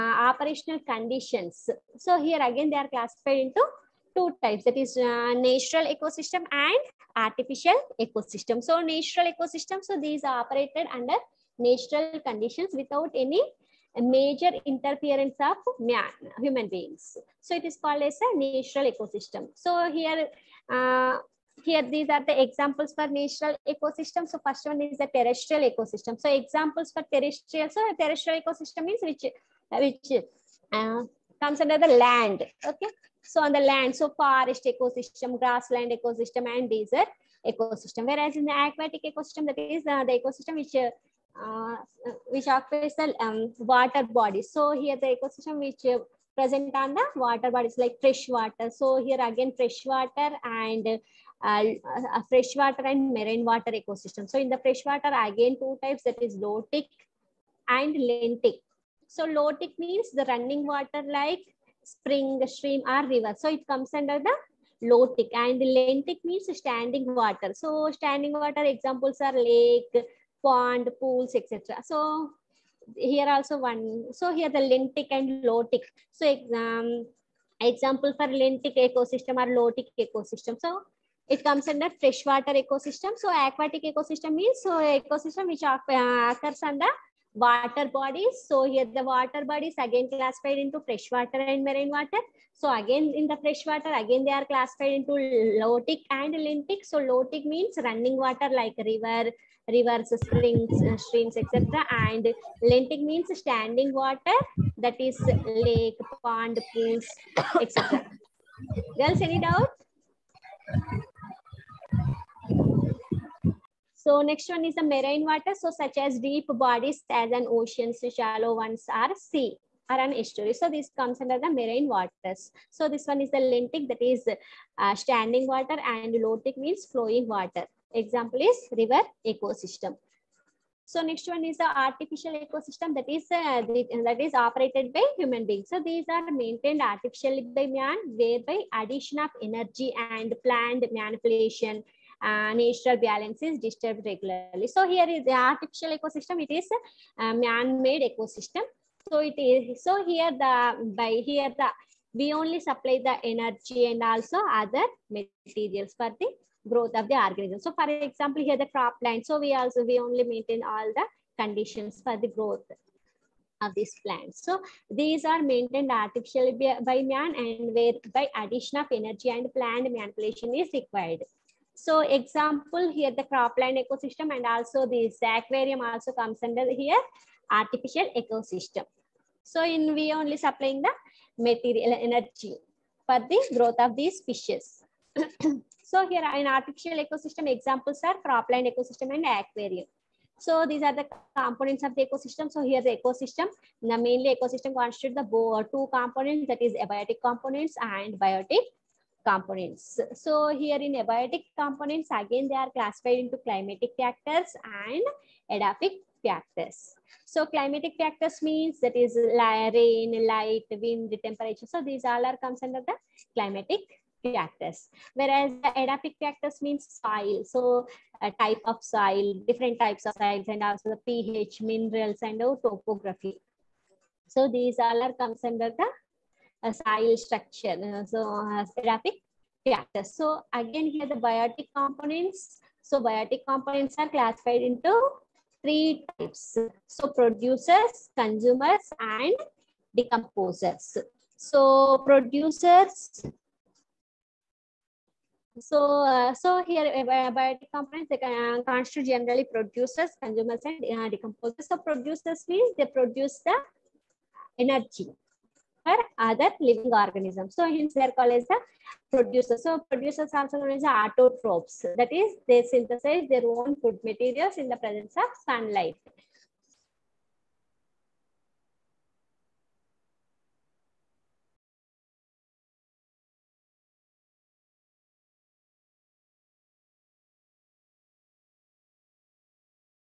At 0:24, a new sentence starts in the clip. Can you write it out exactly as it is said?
So first one is the terrestrial ecosystem.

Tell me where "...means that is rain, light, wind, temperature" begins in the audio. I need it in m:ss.
3:28.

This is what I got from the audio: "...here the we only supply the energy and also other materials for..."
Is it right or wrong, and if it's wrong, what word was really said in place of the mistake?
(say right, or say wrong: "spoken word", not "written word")
right.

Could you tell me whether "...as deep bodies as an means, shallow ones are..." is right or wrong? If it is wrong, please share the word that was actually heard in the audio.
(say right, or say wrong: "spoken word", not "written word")
wrong: "oceans", not "means".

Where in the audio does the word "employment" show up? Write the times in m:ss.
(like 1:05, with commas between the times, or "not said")
not said.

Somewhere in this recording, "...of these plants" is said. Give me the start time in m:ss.
2:43.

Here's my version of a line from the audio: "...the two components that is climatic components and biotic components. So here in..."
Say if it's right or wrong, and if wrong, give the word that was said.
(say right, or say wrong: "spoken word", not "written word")
wrong: "abiotic", not "climatic".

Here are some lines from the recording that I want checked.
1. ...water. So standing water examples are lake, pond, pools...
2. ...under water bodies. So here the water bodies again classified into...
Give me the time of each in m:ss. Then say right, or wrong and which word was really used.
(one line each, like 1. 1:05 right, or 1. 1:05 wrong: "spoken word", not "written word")
1. 1:07 right
2. 1:26 right.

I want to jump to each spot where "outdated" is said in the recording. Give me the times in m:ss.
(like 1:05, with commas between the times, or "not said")
not said.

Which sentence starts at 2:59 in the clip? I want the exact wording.
So in we only supplying the material energy for the growth of these fishes.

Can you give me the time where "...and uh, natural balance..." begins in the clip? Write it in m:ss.
2:22.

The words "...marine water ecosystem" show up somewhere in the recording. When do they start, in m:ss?
0:53.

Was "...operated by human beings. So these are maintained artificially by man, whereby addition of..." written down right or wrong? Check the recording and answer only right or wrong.
right.